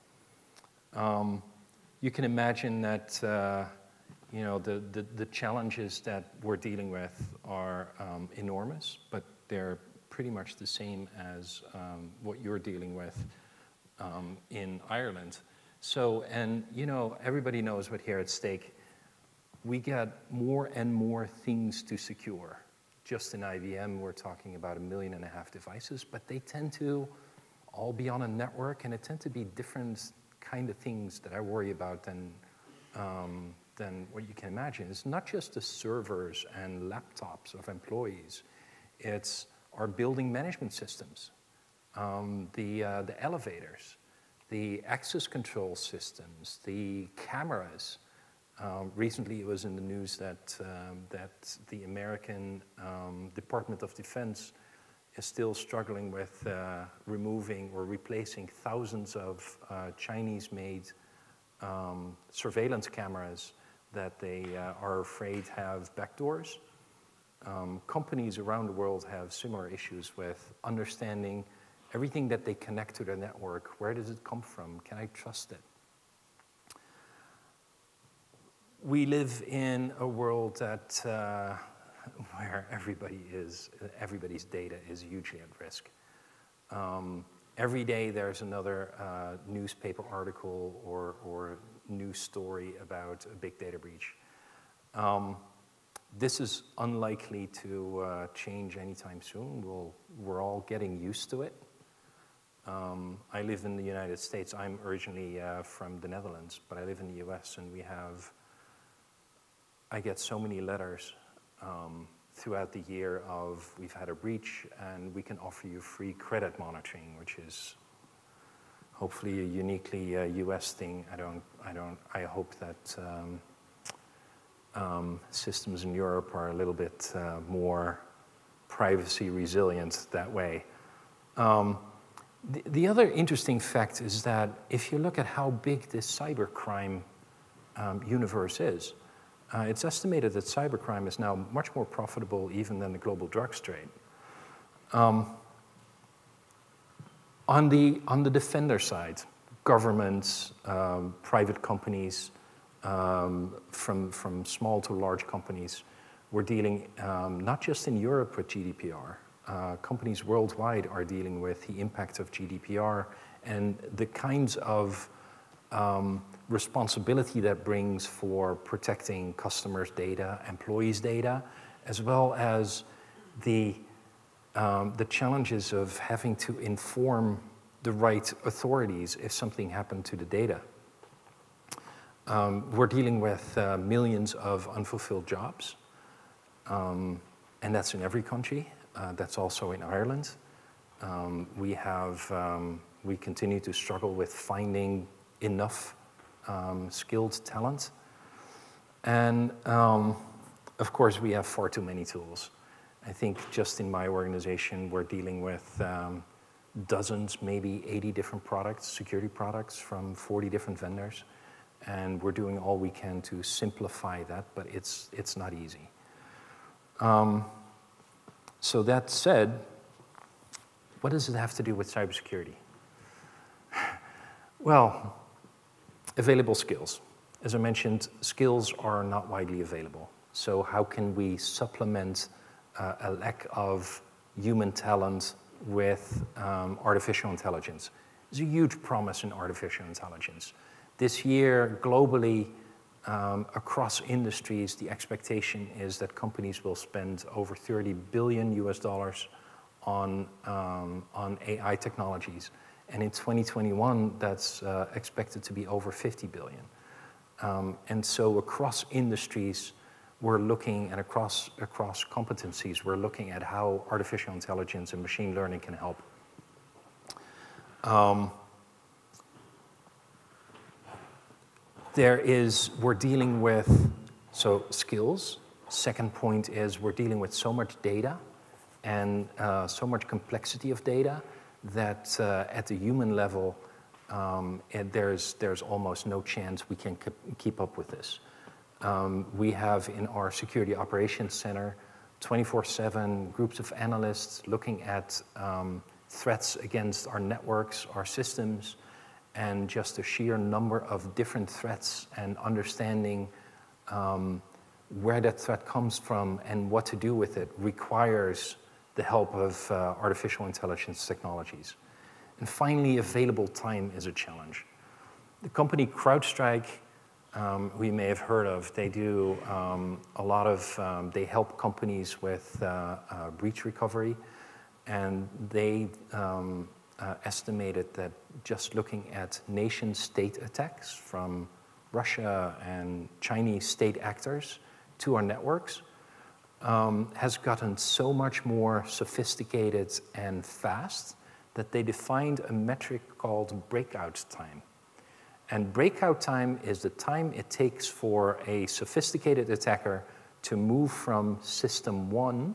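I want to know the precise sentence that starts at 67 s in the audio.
Um, companies around the world have similar issues with understanding everything that they connect to their network.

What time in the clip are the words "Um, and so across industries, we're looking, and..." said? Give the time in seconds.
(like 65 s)
257 s.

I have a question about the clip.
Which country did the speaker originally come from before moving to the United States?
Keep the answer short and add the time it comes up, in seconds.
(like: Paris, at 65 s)
the Netherlands, at 106 s.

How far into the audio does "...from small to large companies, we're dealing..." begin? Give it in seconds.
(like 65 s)
154 s.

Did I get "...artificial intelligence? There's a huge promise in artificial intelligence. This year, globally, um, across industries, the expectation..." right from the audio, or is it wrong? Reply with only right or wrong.
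right.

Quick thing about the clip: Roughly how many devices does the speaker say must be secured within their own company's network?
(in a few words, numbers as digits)
1.5 million.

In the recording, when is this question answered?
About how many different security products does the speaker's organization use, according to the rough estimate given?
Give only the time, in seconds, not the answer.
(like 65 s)
207 s.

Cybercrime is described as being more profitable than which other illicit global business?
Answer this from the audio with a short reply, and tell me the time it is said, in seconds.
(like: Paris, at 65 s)
global drugs trade, at 142 s.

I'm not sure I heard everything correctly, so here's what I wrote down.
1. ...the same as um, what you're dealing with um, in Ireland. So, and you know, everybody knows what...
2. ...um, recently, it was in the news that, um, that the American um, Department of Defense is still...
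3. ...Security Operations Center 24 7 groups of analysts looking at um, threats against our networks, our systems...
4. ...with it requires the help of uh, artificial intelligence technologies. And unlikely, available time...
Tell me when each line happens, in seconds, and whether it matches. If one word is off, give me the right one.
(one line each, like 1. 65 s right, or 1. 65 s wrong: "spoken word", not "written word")
1. 10 s right
2. 48 s right
3. 290 s right
4. 307 s wrong: "finally", not "unlikely".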